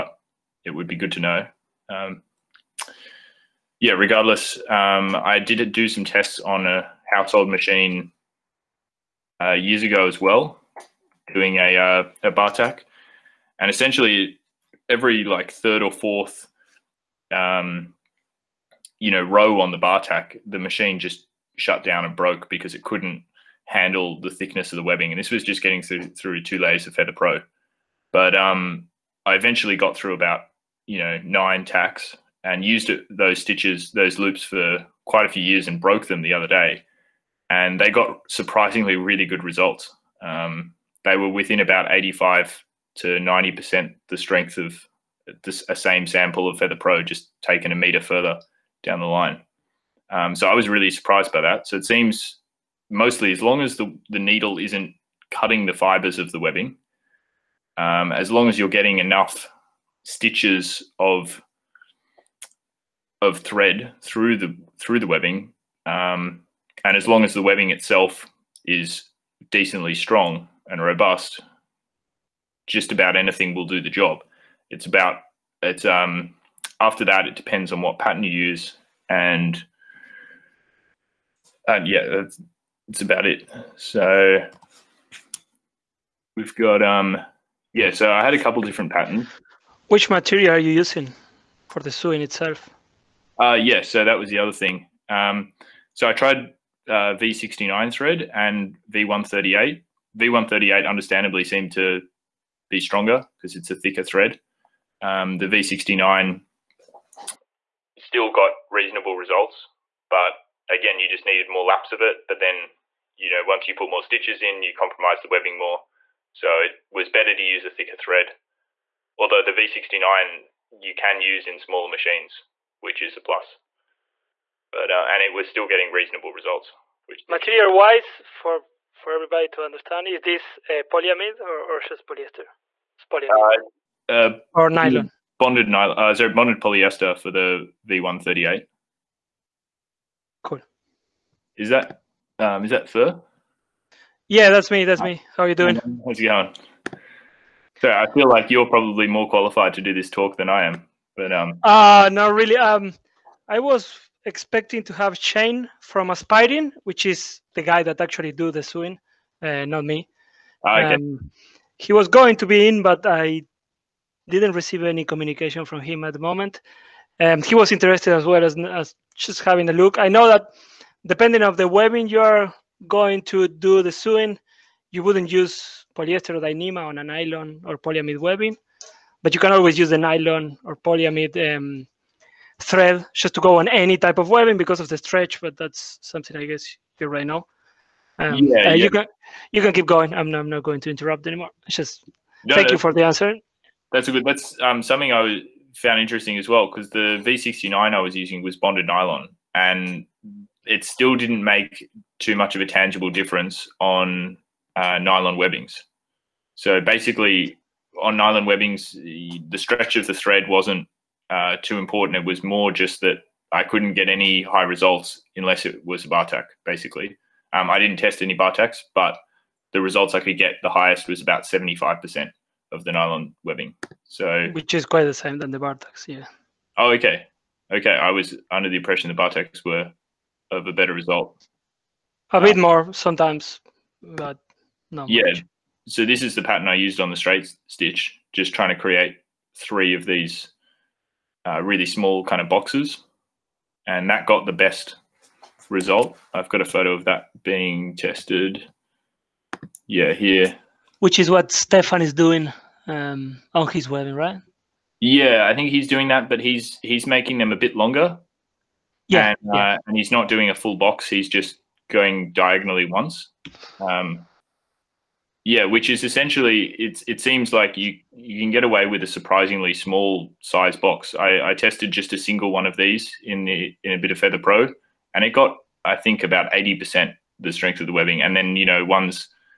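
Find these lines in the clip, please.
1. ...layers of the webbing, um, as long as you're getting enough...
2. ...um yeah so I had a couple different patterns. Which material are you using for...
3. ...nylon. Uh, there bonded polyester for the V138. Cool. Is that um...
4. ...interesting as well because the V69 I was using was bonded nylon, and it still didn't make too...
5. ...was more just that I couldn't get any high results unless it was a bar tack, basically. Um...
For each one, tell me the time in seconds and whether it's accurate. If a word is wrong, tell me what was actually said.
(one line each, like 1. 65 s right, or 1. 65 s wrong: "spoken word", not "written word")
1. 55 s wrong: "fibers", not "layers"
2. 86 s right
3. 135 s right
4. 195 s right
5. 212 s right.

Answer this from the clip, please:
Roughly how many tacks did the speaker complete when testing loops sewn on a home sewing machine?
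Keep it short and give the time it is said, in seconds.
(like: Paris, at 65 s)
9, at 31 s.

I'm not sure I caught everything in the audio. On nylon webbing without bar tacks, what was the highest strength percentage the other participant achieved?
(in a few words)
75%.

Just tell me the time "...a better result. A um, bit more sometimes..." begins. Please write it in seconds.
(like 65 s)
230 s.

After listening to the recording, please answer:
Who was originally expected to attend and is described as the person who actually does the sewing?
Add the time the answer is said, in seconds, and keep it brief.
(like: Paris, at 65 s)
Shane, at 155 s.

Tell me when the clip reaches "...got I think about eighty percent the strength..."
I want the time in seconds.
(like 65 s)
275 s.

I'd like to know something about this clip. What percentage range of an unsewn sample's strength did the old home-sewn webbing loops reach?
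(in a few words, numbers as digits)
85 to 90%.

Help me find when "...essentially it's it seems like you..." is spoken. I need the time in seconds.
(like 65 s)
266 s.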